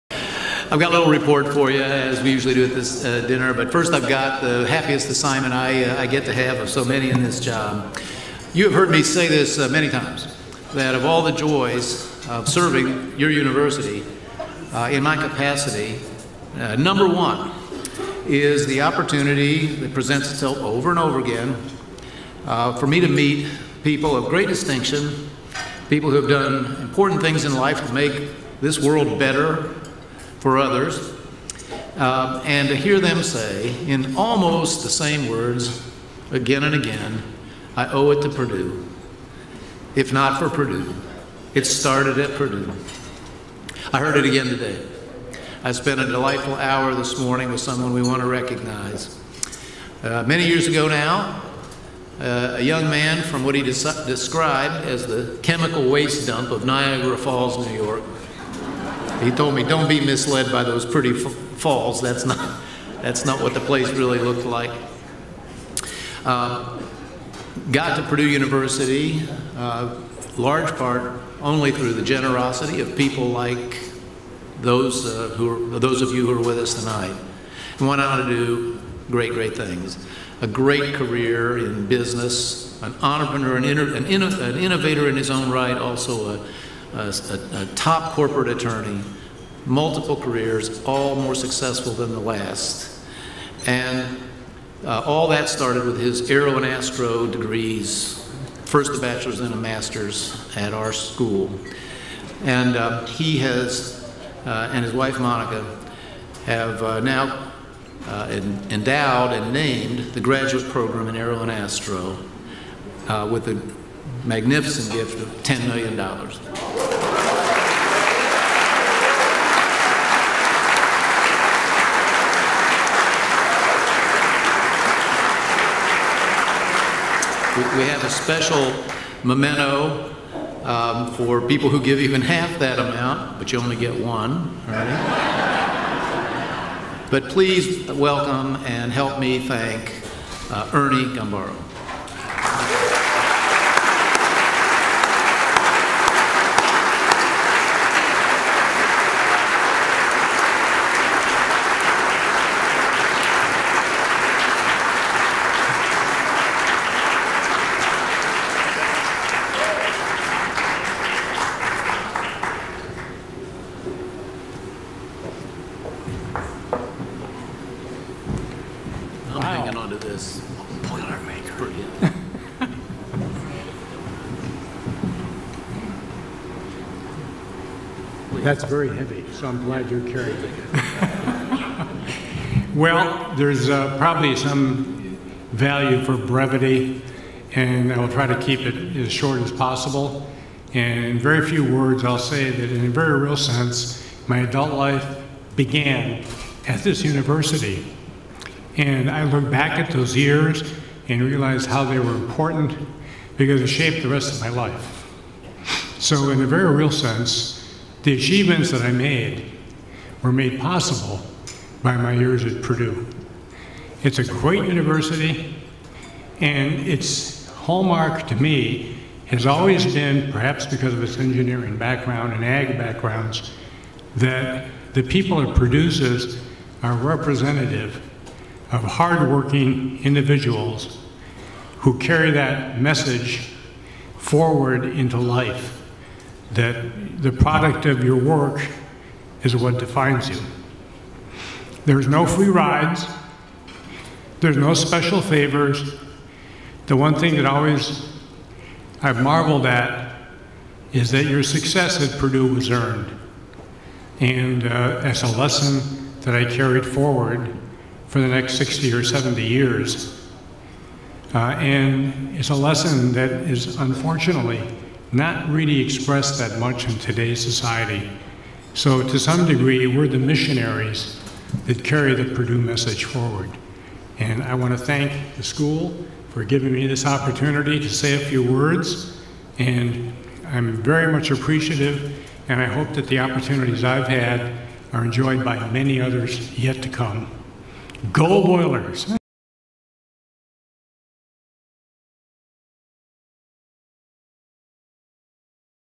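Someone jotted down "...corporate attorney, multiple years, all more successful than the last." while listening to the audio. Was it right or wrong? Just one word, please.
wrong.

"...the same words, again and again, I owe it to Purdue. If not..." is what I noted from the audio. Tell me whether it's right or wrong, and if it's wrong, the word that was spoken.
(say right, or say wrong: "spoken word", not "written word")
right.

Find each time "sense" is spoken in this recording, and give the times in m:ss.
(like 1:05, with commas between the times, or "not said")
3:13, 3:26.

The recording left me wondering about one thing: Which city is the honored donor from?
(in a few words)
Niagara Falls, New York.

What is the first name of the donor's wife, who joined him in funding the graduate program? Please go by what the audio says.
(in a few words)
Monica.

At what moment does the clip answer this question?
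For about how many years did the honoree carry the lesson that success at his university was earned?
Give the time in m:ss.
4:18.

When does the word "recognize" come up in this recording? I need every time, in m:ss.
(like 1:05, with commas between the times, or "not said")
0:48.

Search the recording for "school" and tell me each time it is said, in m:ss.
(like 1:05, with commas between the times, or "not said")
1:40, 4:35.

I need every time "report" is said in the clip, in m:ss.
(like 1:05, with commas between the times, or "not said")
0:01.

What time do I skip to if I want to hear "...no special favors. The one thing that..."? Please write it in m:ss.
4:04.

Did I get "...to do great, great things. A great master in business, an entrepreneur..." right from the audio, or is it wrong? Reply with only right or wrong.
wrong.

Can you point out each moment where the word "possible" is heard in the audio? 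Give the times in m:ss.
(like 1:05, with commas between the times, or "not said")
3:09, 3:30.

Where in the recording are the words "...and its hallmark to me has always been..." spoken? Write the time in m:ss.
3:36.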